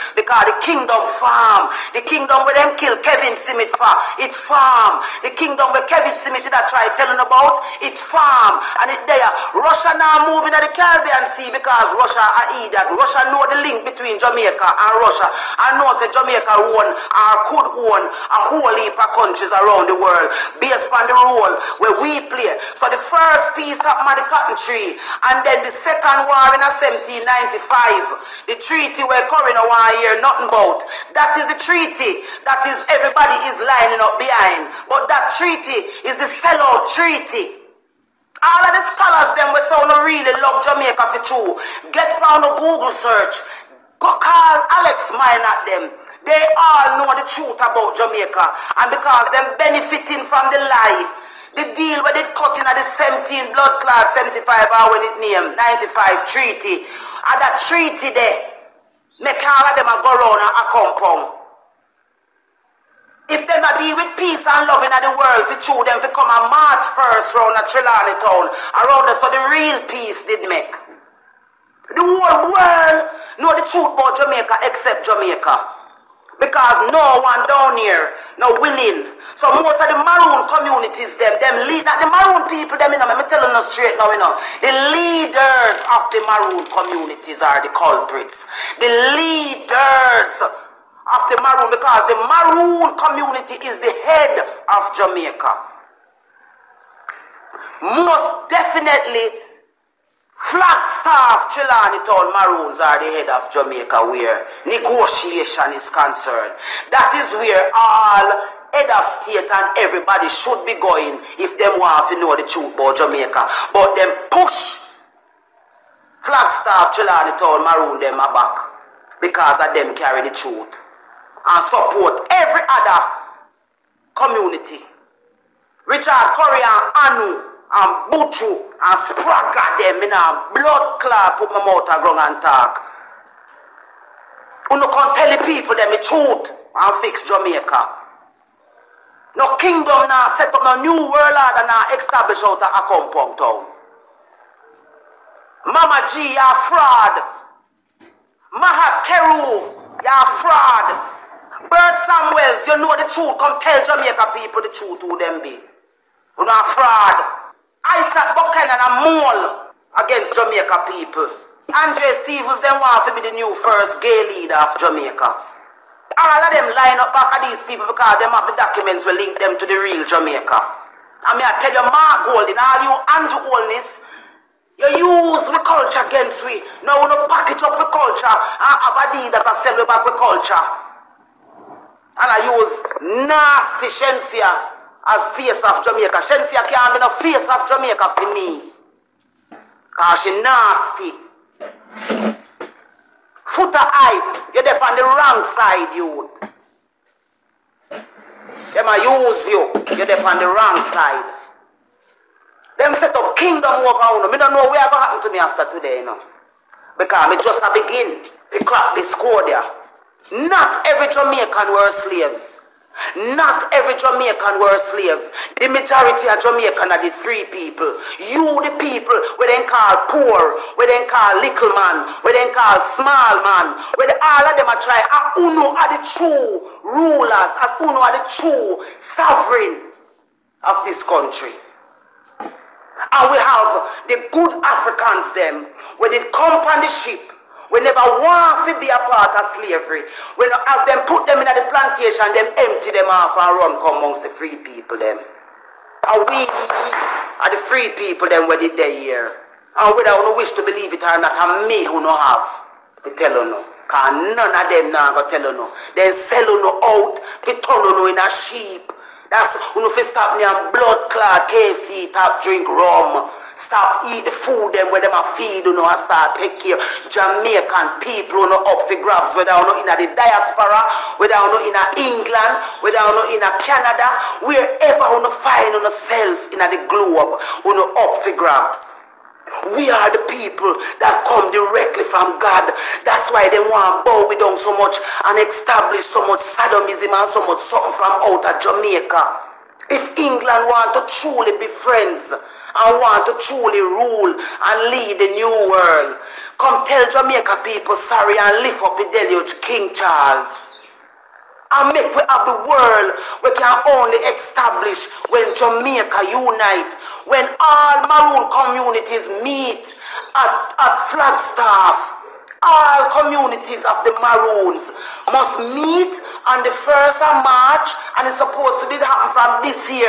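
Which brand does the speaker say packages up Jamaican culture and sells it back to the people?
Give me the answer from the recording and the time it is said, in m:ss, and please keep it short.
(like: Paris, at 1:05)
Adidas, at 2:59.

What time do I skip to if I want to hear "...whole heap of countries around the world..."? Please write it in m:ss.
0:18.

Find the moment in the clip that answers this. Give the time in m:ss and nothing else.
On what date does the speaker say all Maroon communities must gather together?
5:16.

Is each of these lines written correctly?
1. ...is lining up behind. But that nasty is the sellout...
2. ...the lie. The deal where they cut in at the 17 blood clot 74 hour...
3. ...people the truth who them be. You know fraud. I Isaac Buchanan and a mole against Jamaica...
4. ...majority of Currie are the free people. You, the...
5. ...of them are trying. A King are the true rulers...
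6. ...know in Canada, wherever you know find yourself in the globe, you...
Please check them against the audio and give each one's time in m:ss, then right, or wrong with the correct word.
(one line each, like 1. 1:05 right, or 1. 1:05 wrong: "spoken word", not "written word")
1. 0:33 wrong: "treaty", not "nasty"
2. 0:50 wrong: "75", not "74"
3. 2:34 right
4. 3:35 wrong: "Jamaicans", not "Currie"
5. 3:44 wrong: "Uno", not "King"
6. 4:33 right.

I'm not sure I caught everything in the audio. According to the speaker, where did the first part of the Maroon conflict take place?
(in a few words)
the cotton tree.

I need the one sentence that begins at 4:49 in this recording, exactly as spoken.
If England want to truly be friends, I want to truly rule and lead the new world.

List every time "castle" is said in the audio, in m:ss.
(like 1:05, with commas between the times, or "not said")
not said.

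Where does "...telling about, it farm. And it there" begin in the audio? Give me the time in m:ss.
0:06.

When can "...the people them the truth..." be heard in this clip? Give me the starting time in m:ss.
2:15.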